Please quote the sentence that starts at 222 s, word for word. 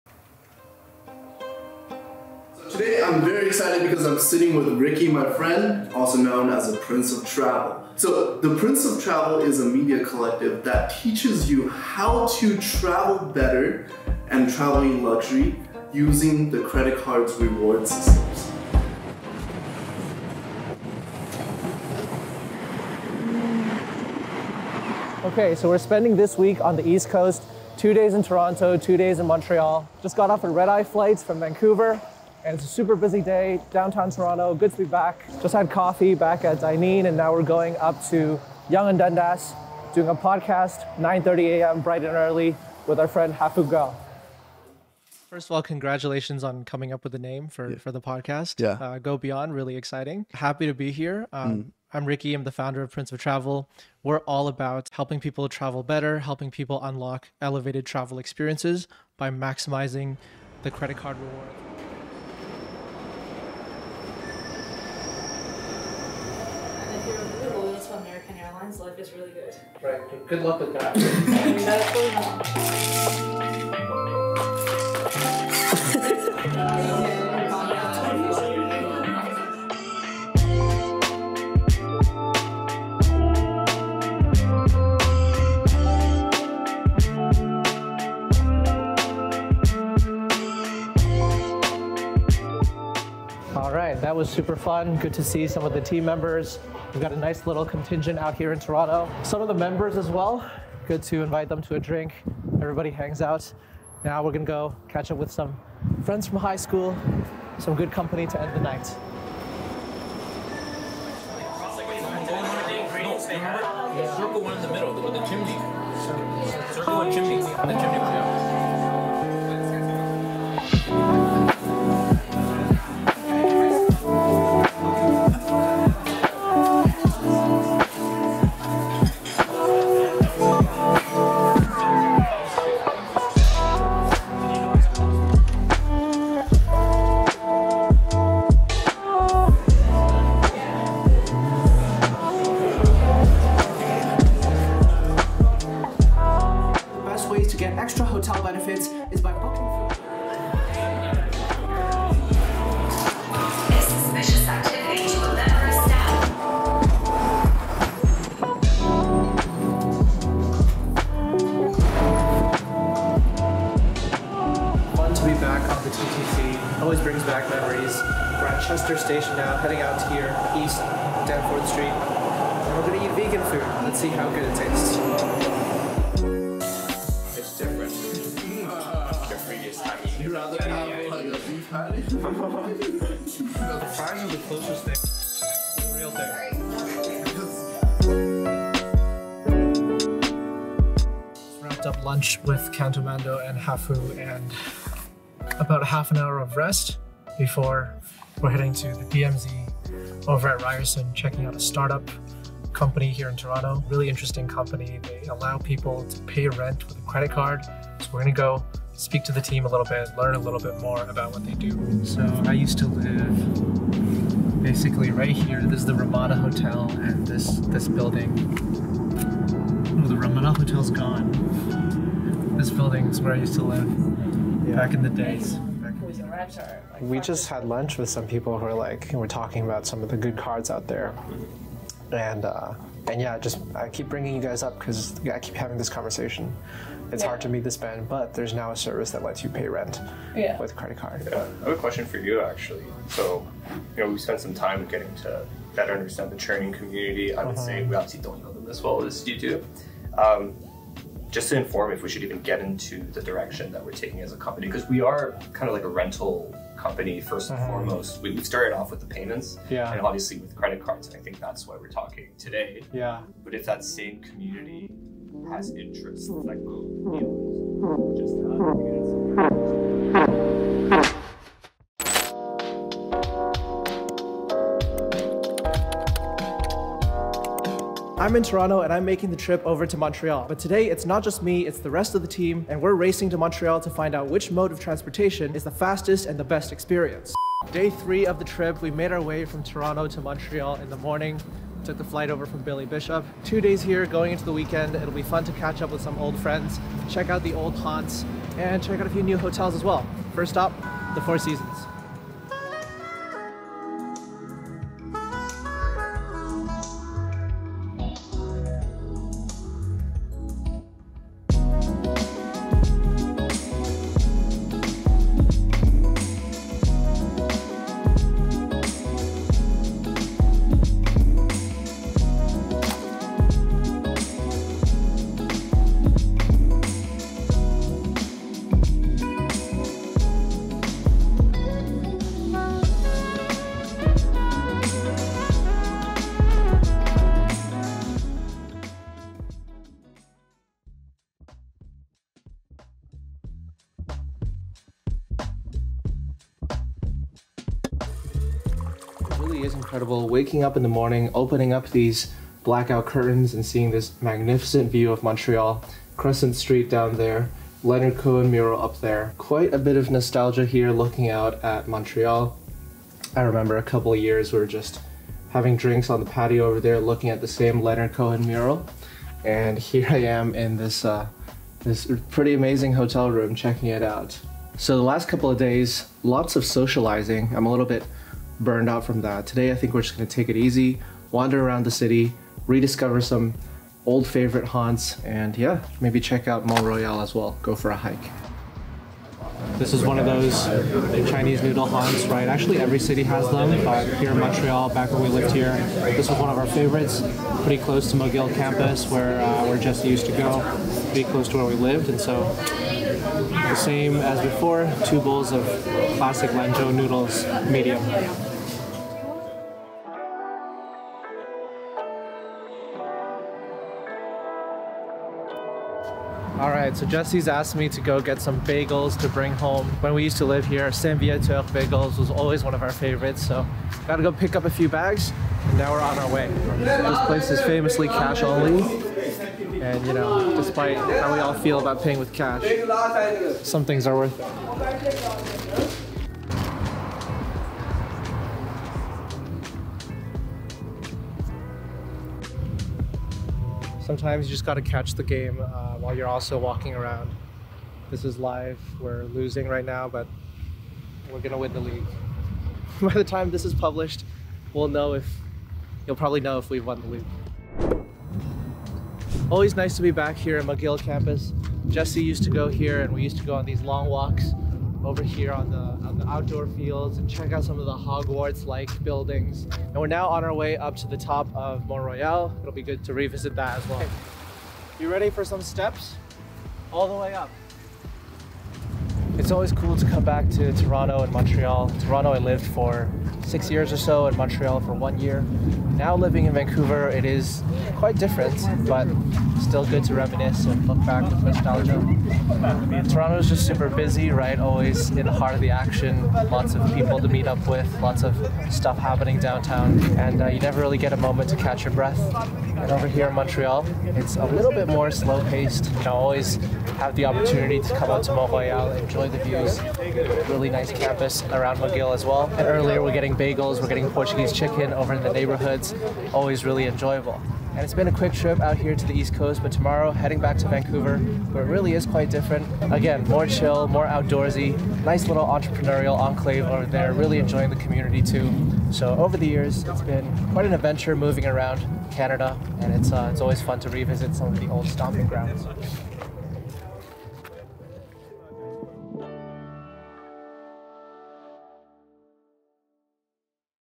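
This building is where I used to live yeah.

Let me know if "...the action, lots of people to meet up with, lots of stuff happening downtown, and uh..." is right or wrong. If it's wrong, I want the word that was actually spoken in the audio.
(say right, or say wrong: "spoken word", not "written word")
right.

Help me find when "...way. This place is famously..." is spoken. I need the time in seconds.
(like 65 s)
426 s.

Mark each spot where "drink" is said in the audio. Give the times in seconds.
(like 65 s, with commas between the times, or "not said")
101 s, 365 s.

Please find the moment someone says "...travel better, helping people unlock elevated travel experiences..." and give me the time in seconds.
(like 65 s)
55 s.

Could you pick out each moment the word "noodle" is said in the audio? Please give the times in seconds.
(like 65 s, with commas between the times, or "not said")
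391 s, 406 s.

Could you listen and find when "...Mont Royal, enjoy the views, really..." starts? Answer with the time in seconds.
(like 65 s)
508 s.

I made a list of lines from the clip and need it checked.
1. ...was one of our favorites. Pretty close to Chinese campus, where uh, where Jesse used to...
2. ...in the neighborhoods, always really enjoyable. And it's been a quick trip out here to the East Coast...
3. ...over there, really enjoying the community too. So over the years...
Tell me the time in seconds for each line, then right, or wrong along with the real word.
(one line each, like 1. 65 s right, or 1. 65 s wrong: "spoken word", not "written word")
1. 396 s wrong: "McGill", not "Chinese"
2. 515 s right
3. 526 s right.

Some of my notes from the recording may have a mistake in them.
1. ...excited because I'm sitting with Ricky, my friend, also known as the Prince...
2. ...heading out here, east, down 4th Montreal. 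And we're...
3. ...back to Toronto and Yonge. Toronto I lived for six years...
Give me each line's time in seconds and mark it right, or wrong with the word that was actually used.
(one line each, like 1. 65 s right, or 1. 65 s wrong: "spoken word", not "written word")
1. 3 s right
2. 169 s wrong: "Street", not "Montreal"
3. 480 s wrong: "Montreal", not "Yonge".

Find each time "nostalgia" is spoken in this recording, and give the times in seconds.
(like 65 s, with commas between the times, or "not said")
360 s, 491 s.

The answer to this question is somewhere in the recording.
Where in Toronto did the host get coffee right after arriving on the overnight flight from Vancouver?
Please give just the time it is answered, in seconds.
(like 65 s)
36 s.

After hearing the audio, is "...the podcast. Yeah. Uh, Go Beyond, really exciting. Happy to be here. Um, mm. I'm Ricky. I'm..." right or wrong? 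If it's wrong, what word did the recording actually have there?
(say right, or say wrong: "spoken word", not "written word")
right.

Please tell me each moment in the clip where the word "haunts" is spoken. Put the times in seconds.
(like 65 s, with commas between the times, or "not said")
297 s, 384 s, 391 s.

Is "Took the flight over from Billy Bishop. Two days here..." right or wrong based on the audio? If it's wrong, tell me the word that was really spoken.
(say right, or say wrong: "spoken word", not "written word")
right.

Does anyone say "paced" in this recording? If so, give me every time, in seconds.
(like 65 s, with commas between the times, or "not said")
505 s.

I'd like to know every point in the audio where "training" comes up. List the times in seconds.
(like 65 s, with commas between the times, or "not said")
246 s.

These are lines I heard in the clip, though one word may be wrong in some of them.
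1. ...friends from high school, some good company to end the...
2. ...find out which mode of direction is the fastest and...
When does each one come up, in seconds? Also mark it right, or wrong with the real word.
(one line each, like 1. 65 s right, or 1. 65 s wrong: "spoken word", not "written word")
1. 106 s right
2. 283 s wrong: "transportation", not "direction".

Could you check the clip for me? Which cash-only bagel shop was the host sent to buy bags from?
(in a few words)
Saint Viateur.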